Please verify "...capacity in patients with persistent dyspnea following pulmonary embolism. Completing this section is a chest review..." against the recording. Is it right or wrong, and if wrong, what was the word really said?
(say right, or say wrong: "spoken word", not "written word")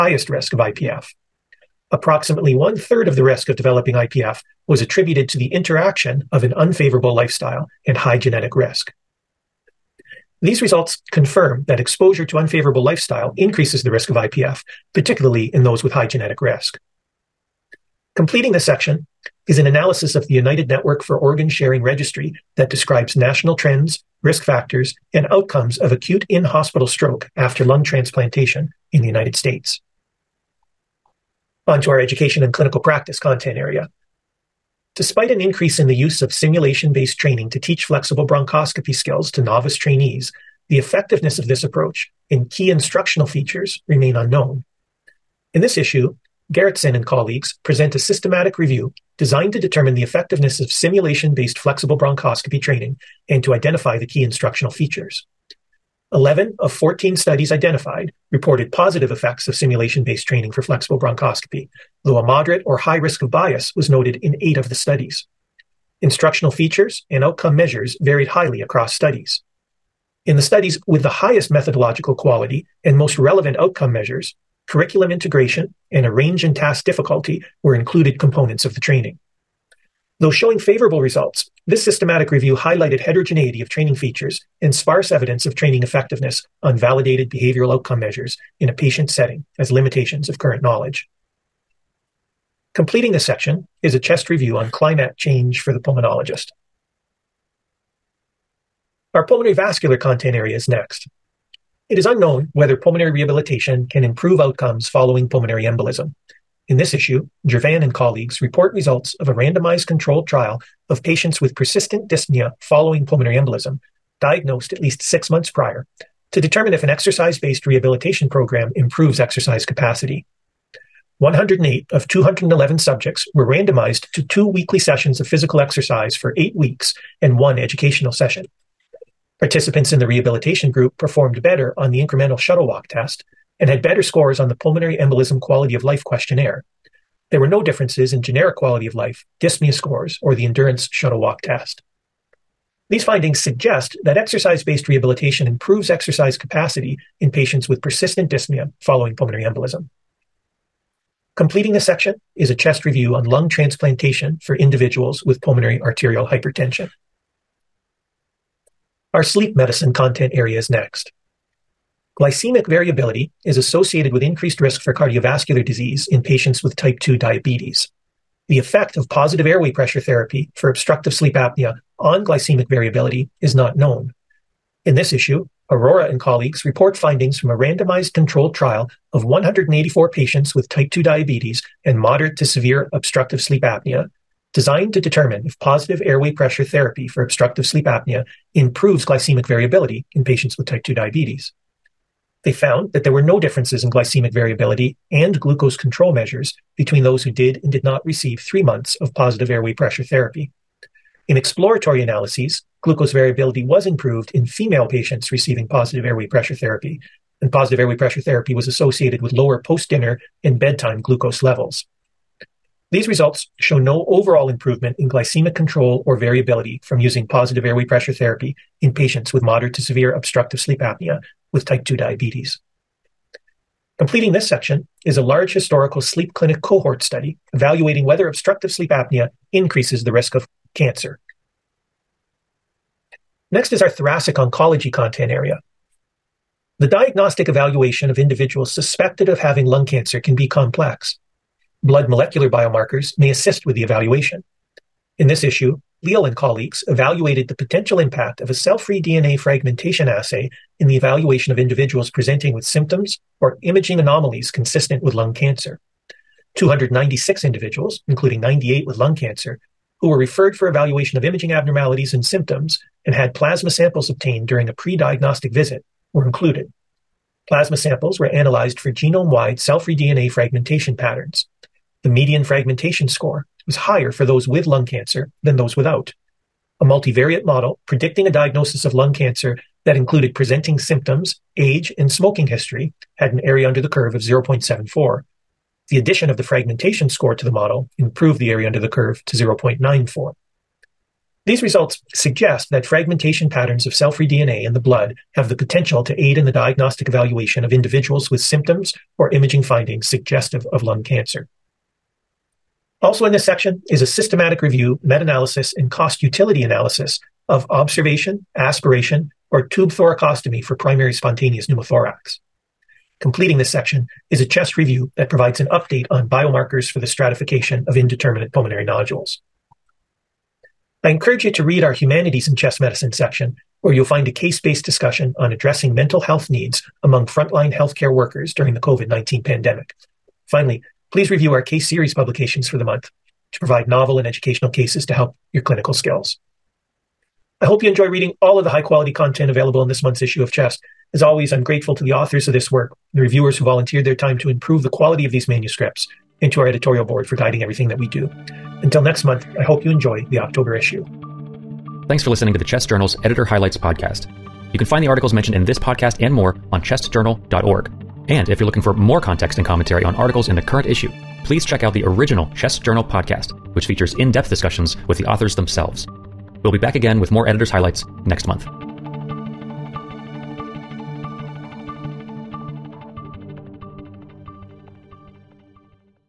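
right.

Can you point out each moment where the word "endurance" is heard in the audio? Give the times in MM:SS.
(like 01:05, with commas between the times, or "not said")
02:20.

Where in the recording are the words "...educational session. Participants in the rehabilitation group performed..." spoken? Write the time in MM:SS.
02:07.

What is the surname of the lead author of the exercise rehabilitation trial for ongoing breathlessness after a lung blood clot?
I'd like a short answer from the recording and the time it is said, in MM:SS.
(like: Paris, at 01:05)
Gervain, at 01:47.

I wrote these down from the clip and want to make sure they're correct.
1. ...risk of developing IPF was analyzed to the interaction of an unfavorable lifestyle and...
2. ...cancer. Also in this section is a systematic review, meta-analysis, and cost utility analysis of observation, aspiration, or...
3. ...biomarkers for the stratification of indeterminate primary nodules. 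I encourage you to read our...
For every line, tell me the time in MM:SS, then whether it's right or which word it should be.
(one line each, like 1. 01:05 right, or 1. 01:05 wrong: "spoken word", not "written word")
1. 00:03 wrong: "attributed", not "analyzed"
2. 05:01 right
3. 05:16 wrong: "pulmonary", not "primary".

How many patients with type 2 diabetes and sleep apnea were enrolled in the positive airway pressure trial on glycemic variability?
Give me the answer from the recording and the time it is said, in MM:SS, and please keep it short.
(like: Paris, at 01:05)
184, at 02:59.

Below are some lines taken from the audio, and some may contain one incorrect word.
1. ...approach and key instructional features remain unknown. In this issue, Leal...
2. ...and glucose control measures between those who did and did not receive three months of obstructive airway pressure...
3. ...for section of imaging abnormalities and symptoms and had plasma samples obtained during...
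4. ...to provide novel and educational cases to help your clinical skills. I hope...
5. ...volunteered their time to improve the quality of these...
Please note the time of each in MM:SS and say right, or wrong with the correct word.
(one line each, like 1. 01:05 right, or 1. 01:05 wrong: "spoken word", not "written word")
1. 00:41 wrong: "Gerritsen", not "Leal"
2. 03:15 wrong: "positive", not "obstructive"
3. 04:20 wrong: "evaluation", not "section"
4. 05:33 right
5. 05:43 right.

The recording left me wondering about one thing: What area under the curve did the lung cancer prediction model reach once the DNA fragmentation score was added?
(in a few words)
0.94.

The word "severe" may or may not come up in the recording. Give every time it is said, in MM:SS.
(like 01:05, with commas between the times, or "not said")
03:02, 03:39.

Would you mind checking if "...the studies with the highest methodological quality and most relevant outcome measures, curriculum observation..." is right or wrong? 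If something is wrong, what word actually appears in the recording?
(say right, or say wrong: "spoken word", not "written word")
wrong: "integration", not "observation".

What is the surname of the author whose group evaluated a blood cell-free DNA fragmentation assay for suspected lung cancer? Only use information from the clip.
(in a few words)
Leal.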